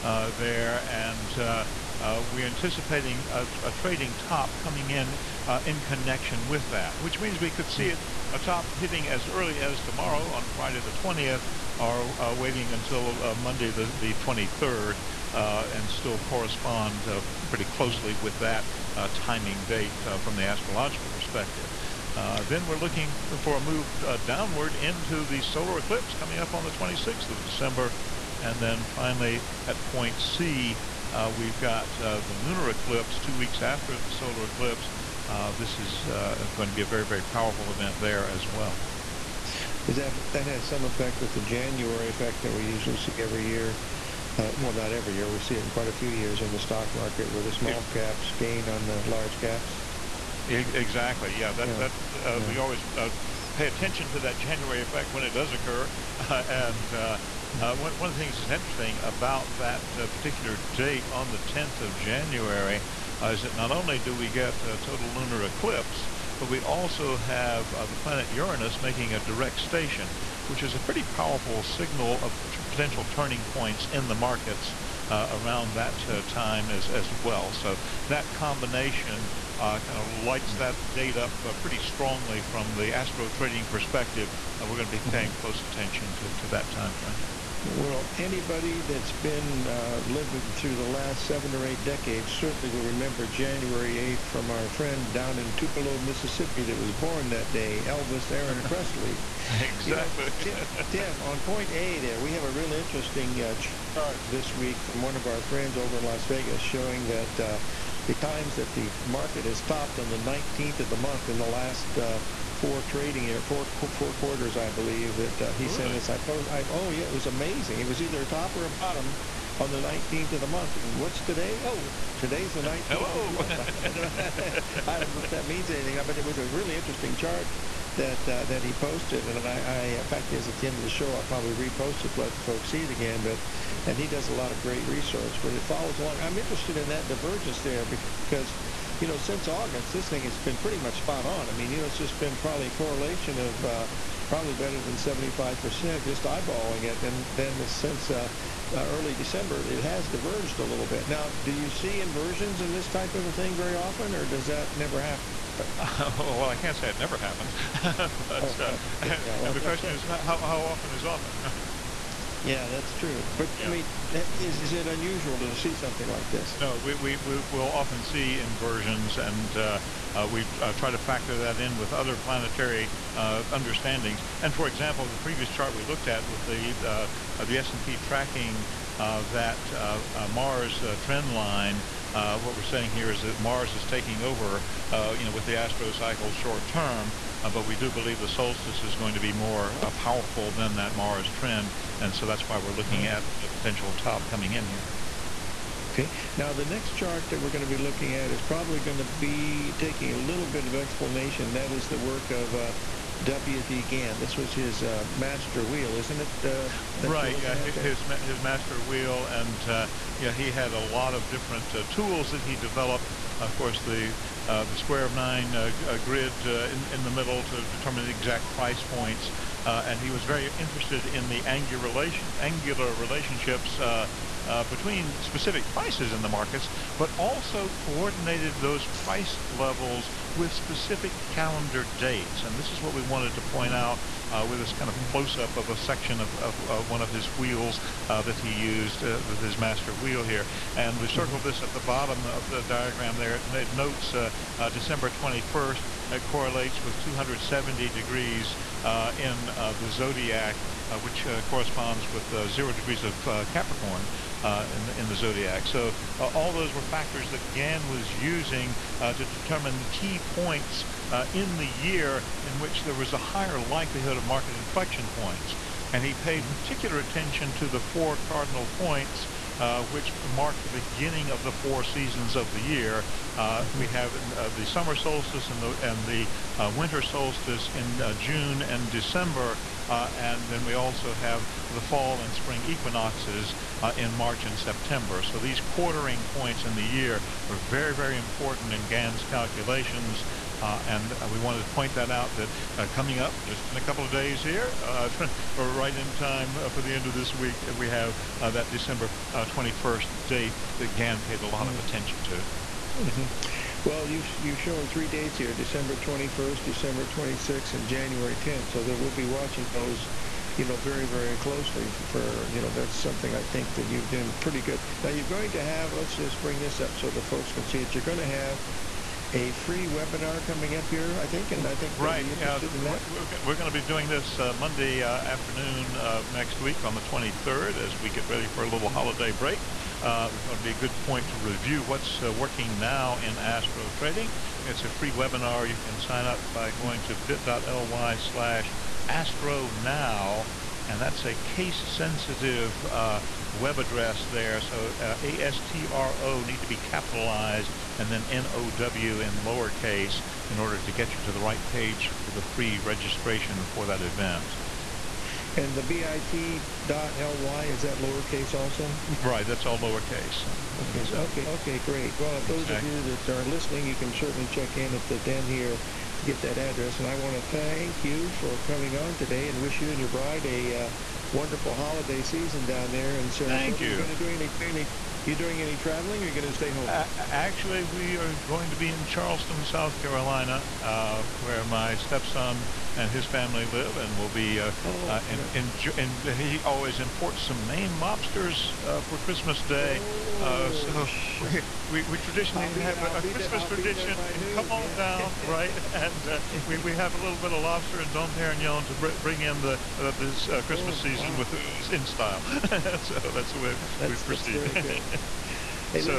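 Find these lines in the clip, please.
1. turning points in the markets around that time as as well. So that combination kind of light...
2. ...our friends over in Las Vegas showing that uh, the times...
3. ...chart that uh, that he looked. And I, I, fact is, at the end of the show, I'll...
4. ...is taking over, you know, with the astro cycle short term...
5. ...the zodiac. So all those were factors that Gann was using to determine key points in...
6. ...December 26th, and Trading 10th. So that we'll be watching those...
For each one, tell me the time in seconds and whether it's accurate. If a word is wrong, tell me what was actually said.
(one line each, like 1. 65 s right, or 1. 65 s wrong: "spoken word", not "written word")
1. 73 s right
2. 105 s right
3. 127 s wrong: "posted", not "looked"
4. 183 s right
5. 255 s right
6. 306 s wrong: "January", not "Trading".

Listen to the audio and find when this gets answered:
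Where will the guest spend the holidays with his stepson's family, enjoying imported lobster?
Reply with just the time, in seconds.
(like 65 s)
379 s.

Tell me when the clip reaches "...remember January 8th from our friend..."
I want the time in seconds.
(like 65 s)
92 s.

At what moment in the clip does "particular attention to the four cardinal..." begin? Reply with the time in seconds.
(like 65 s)
266 s.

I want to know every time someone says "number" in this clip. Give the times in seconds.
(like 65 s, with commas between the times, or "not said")
not said.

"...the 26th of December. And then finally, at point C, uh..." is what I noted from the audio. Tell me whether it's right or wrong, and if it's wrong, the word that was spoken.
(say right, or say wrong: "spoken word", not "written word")
right.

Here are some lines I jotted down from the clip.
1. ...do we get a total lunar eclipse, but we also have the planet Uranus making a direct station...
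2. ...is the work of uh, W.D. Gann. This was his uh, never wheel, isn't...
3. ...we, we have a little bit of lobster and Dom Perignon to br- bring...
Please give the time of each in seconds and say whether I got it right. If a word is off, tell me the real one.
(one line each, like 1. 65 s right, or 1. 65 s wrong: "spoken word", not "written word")
1. 63 s right
2. 201 s wrong: "master", not "never"
3. 396 s right.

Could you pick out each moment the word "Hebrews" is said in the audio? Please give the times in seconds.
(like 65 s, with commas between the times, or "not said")
not said.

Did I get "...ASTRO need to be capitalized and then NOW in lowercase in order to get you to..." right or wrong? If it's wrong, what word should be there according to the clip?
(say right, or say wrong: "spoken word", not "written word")
right.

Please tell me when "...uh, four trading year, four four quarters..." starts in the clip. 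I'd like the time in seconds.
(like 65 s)
111 s.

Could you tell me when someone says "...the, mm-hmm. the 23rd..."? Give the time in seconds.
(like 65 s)
13 s.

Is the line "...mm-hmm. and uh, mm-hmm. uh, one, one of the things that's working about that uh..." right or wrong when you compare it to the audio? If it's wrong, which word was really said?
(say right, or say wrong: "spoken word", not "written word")
wrong: "interesting", not "working".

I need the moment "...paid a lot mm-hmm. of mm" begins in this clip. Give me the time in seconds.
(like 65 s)
301 s.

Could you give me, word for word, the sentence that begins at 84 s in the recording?
Uh, we're going to be mm-hmm.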